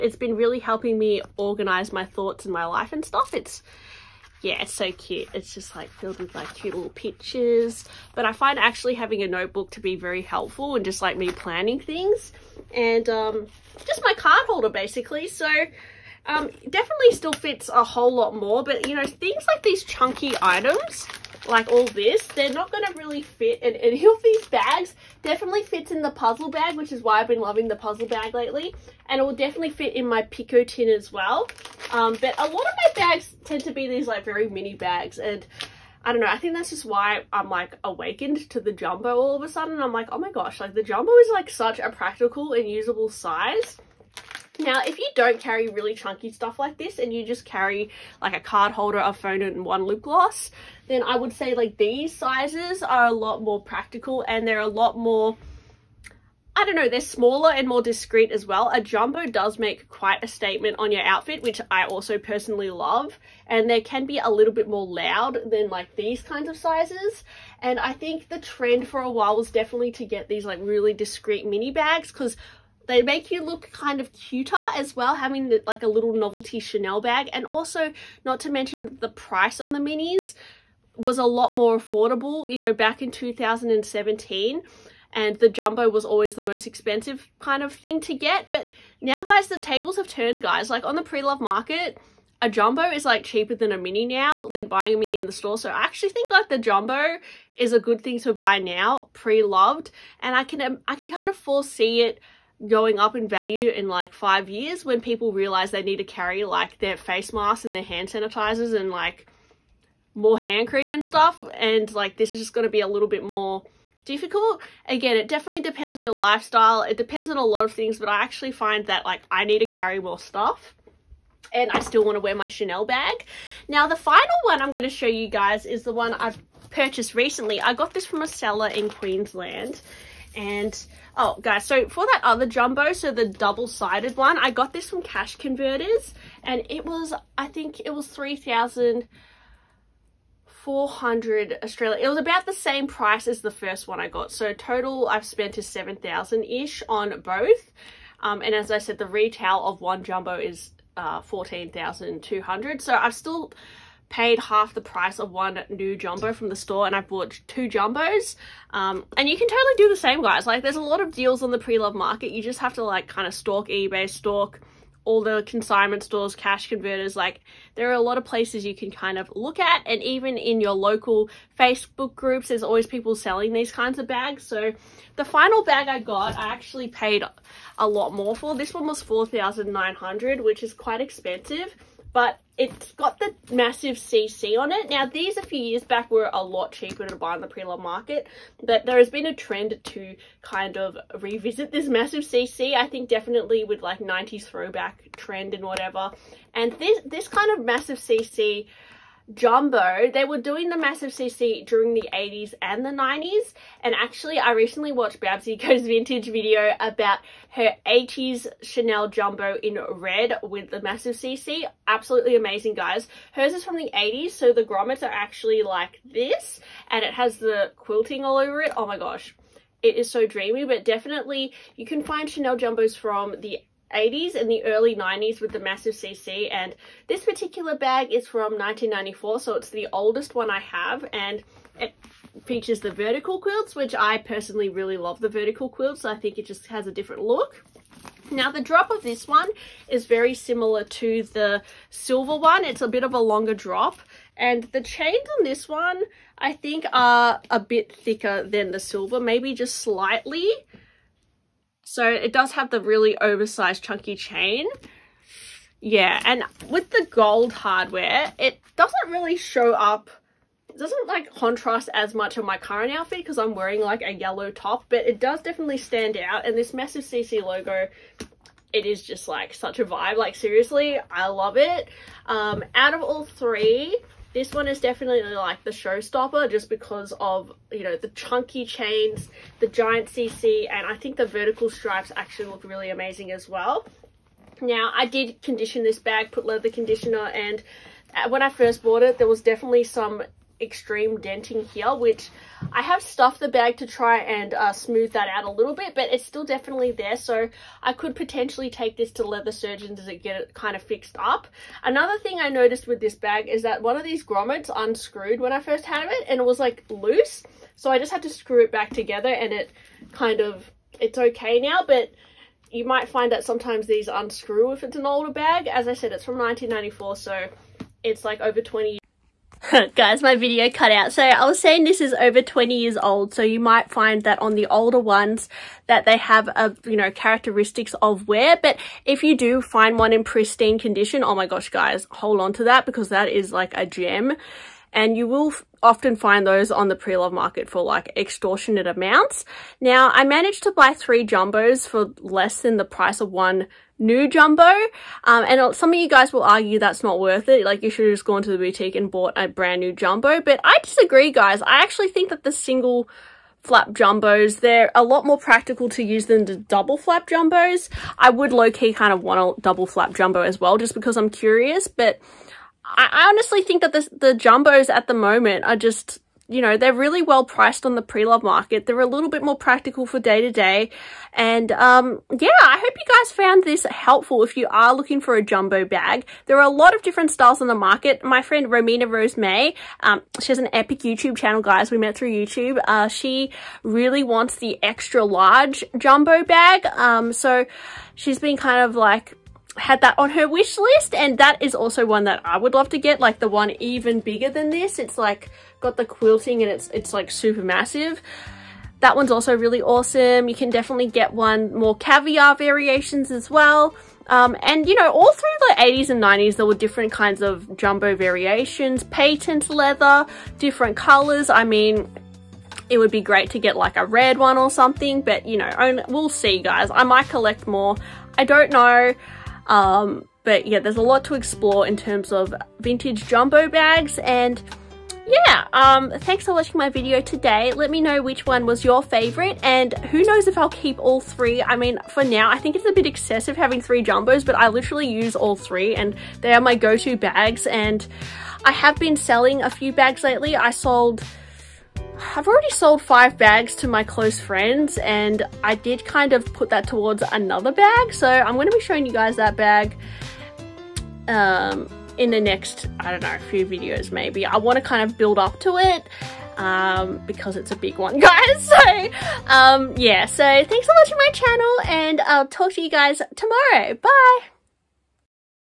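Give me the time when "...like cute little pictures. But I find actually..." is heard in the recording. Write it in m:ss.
0:06.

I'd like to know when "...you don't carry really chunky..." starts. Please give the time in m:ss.
0:44.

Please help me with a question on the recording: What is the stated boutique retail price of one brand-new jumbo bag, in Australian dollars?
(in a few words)
14,200.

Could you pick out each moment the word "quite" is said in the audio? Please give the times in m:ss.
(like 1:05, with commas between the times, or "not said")
0:59, 3:00.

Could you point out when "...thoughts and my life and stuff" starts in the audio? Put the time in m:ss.
0:02.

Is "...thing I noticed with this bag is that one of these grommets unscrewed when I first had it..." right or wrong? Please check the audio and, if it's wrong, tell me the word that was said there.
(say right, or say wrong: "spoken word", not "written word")
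right.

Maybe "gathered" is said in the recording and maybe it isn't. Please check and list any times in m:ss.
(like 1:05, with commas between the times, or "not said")
not said.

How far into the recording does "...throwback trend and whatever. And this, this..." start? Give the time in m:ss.
3:14.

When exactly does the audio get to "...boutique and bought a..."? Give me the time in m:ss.
5:48.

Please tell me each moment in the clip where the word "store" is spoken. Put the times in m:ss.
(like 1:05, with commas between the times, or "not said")
1:35, 2:36, 2:46.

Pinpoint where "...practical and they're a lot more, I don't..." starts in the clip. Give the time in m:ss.
0:53.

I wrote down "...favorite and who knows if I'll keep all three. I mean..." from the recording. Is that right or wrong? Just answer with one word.
right.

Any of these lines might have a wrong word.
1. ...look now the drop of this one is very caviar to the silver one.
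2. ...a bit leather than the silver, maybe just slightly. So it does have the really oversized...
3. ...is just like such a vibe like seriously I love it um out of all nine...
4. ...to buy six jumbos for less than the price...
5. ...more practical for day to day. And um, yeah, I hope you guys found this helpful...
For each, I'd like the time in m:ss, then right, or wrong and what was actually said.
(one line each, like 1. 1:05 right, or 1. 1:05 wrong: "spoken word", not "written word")
1. 3:57 wrong: "similar", not "caviar"
2. 4:07 wrong: "thicker", not "leather"
3. 4:28 wrong: "three", not "nine"
4. 5:40 wrong: "three", not "six"
5. 6:09 right.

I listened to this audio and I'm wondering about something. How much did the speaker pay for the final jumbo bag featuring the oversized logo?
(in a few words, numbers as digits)
4,900.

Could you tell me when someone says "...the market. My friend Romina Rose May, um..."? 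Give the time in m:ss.
6:17.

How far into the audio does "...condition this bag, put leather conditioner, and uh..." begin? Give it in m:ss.
4:45.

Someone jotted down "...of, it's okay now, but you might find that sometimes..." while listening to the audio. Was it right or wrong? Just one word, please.
right.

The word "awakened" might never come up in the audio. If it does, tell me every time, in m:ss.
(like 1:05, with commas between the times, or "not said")
0:37.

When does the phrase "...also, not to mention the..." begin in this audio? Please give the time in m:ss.
1:17.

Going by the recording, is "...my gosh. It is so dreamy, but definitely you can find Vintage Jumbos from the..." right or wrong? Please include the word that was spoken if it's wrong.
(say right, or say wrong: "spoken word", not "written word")
wrong: "Chanel", not "Vintage".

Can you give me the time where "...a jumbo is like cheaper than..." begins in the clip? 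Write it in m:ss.
1:32.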